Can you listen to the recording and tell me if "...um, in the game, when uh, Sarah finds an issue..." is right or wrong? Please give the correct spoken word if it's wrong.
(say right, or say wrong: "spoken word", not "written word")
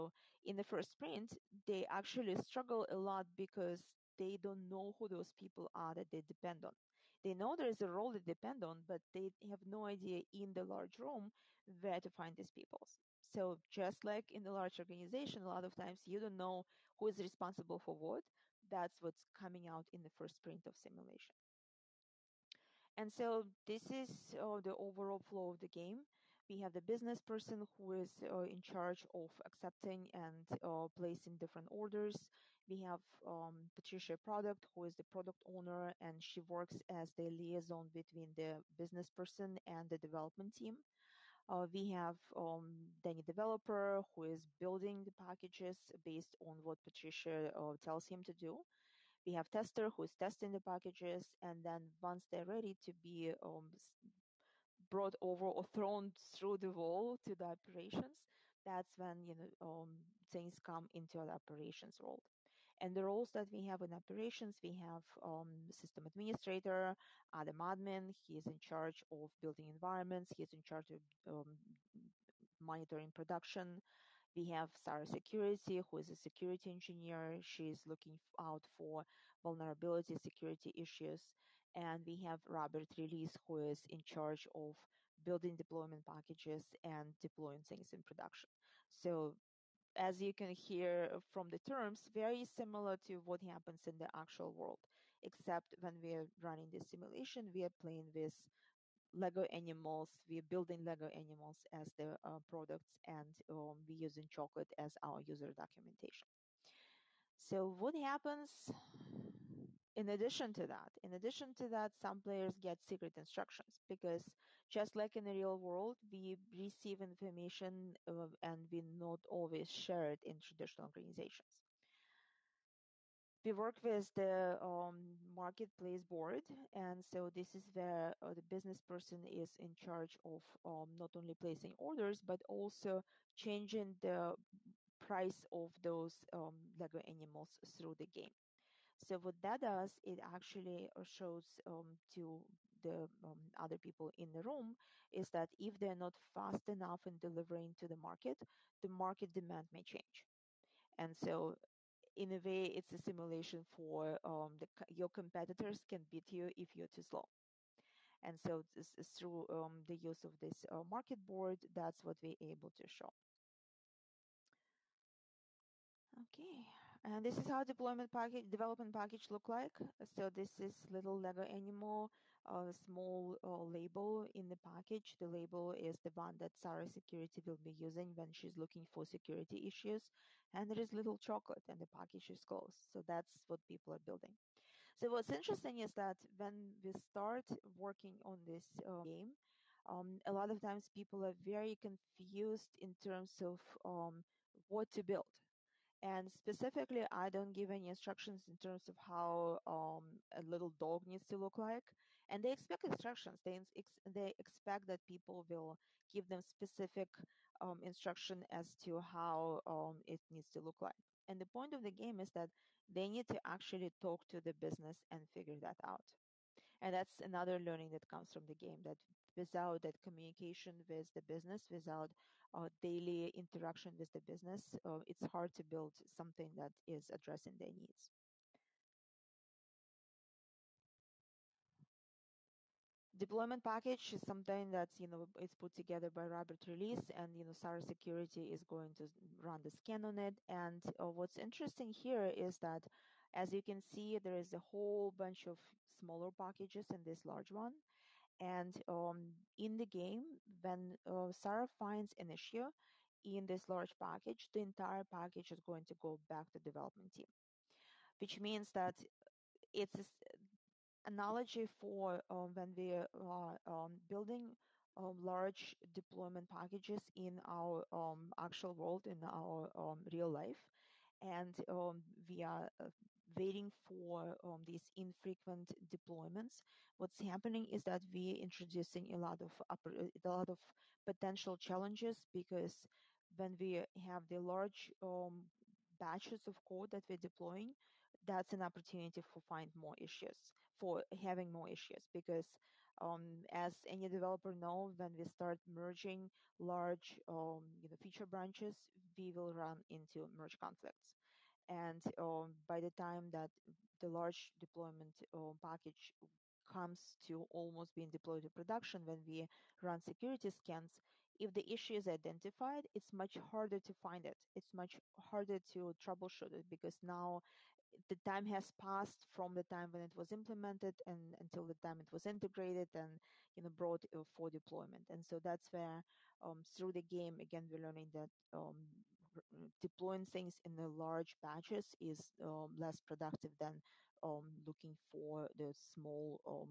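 right.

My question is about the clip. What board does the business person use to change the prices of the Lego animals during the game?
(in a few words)
marketplace board.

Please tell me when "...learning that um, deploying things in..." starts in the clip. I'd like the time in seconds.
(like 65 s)
327 s.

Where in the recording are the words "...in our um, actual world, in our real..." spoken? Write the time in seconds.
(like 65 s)
267 s.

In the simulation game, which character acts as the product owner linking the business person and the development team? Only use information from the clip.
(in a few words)
Patricia Product.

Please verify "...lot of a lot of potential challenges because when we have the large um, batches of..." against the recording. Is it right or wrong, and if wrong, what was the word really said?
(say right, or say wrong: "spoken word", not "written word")
right.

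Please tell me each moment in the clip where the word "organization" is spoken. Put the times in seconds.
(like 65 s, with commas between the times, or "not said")
14 s, 120 s.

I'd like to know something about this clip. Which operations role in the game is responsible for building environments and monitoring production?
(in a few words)
Adam admin.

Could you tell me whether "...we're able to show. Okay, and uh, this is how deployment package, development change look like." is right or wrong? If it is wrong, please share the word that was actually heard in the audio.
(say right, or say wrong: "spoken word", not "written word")
wrong: "package", not "change".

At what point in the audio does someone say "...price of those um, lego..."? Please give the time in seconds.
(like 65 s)
134 s.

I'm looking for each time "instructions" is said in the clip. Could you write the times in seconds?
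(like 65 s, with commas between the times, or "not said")
113 s, 197 s, 202 s, 207 s.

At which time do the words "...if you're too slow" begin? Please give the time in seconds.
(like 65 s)
156 s.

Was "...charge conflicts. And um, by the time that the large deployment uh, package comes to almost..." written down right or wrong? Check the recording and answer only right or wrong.
wrong.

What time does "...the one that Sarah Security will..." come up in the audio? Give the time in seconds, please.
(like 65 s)
175 s.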